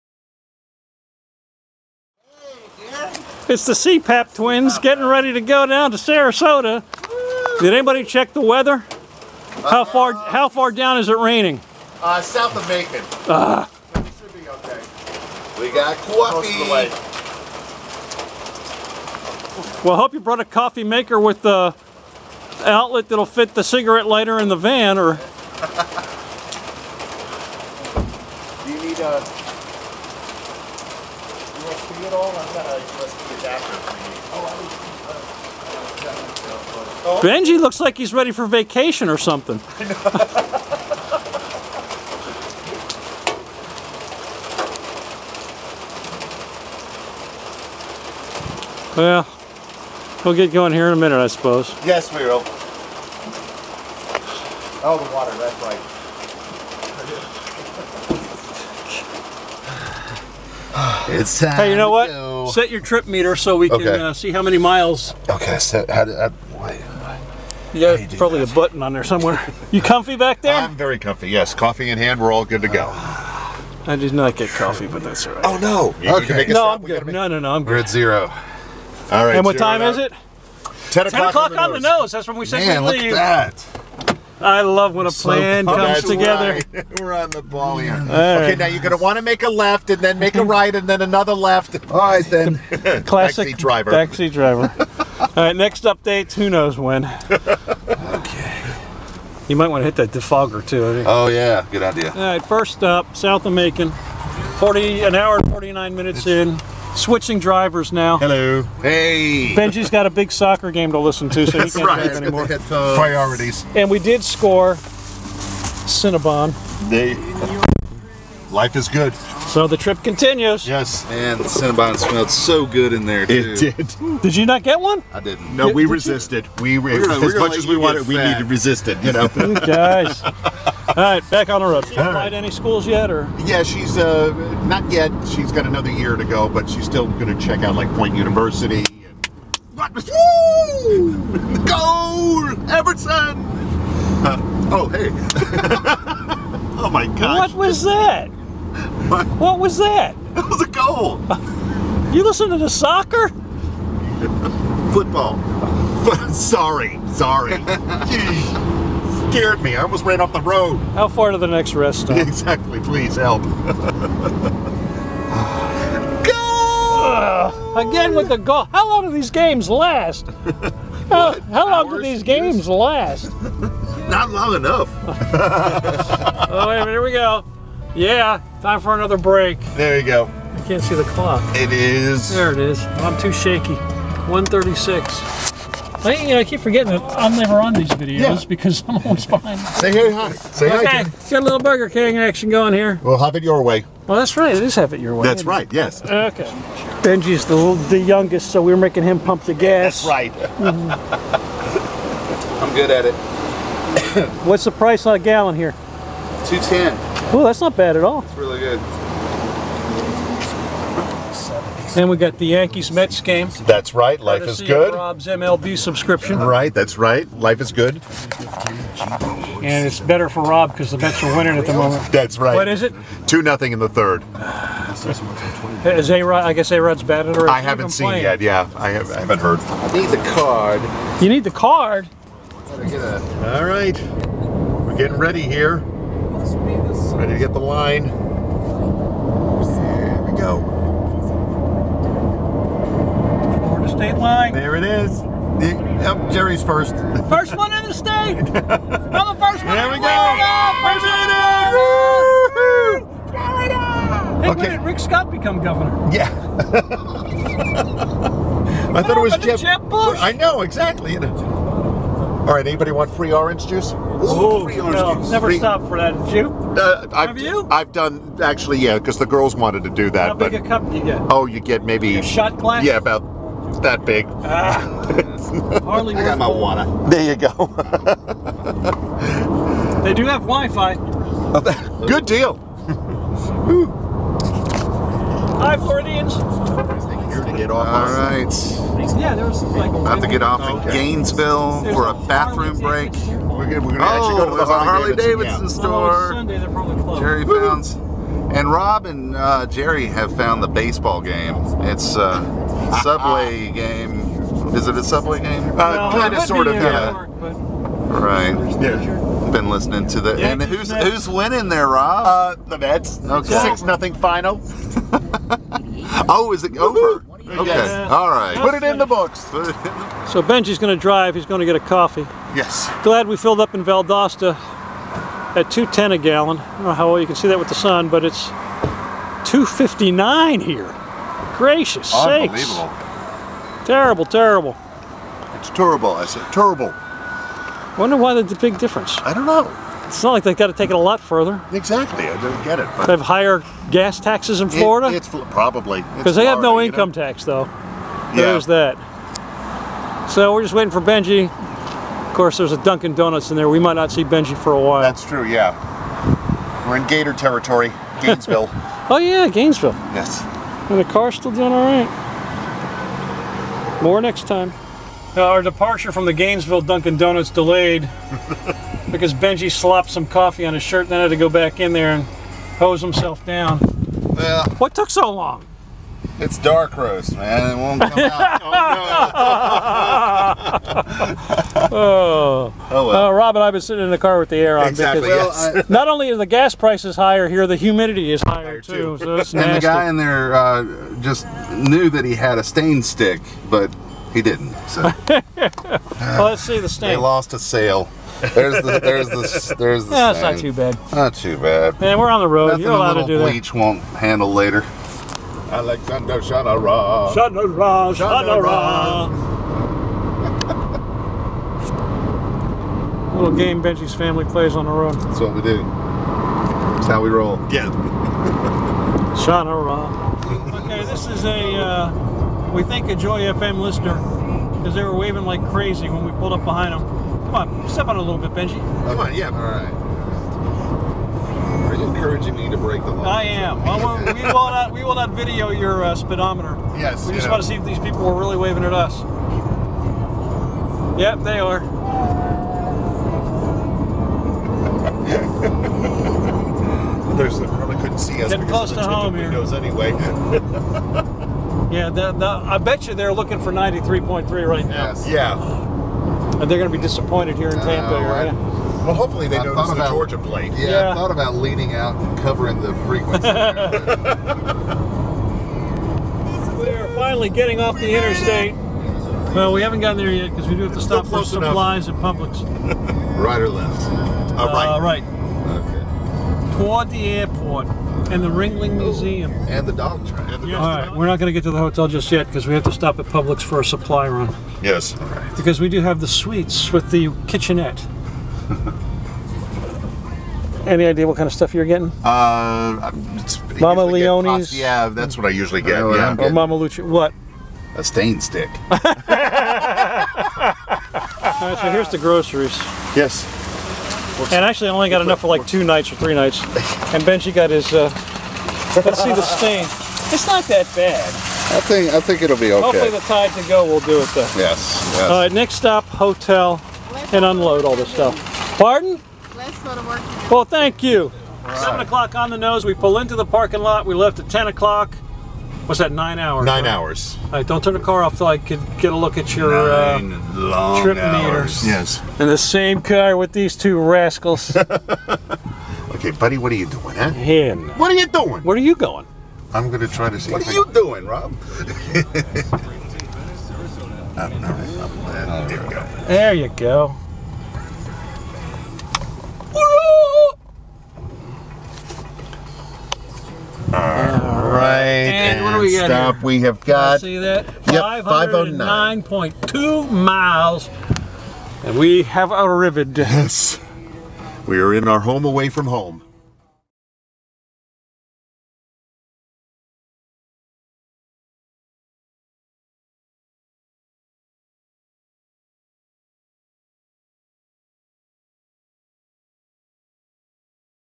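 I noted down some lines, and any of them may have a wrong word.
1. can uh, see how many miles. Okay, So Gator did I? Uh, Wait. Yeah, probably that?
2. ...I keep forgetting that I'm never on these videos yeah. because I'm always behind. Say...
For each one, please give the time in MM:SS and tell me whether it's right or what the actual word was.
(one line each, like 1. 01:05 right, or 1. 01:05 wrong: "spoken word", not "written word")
1. 01:03 wrong: "How", not "Gator"
2. 03:06 right.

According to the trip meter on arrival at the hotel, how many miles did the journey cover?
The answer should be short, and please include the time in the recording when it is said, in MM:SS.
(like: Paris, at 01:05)
509.2, at 09:17.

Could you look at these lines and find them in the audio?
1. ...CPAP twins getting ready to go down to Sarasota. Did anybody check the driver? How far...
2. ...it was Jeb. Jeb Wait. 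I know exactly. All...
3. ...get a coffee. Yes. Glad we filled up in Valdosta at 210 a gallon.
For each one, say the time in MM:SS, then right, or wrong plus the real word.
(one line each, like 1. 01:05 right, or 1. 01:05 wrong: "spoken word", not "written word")
1. 00:03 wrong: "weather", not "driver"
2. 04:19 wrong: "Bush", not "Wait"
3. 05:21 right.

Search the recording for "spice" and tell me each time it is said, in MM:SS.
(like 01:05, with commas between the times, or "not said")
not said.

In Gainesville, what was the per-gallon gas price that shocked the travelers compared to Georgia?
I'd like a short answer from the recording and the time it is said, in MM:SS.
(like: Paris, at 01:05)
$2.59, at 05:29.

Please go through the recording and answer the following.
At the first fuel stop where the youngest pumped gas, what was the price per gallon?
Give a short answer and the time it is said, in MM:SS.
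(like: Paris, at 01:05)
$2.10, at 03:26.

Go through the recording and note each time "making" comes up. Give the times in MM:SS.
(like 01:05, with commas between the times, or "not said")
03:18.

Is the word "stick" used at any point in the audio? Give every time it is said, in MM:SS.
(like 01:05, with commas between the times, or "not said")
06:33, 08:18.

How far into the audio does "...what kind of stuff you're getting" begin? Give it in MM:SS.
08:11.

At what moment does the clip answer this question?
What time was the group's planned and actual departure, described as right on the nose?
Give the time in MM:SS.
01:20.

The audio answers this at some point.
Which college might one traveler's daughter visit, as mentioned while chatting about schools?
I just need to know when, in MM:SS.
02:17.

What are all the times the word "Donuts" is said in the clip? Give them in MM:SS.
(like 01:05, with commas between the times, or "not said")
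05:53, 06:07.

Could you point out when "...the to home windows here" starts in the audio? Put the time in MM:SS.
07:28.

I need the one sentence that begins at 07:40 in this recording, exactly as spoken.
Yeah, yeah, I thought about leaning out and covering the frequency.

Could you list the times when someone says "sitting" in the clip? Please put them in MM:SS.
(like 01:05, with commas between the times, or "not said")
06:23.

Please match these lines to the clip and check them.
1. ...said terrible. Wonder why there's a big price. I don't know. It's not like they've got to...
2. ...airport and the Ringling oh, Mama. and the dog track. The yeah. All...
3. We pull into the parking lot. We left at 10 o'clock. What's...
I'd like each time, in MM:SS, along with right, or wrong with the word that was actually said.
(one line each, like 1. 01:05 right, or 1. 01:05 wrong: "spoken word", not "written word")
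1. 05:36 wrong: "difference", not "price"
2. 07:57 wrong: "Museum", not "Mama"
3. 08:42 right.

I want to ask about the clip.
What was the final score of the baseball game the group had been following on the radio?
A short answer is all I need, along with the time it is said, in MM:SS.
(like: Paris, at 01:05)
6-0, at 05:13.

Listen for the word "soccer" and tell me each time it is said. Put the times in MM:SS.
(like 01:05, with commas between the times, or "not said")
01:50, 02:32.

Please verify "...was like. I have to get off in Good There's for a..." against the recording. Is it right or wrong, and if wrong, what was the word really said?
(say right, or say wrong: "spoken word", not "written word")
wrong: "Gainesville", not "Good".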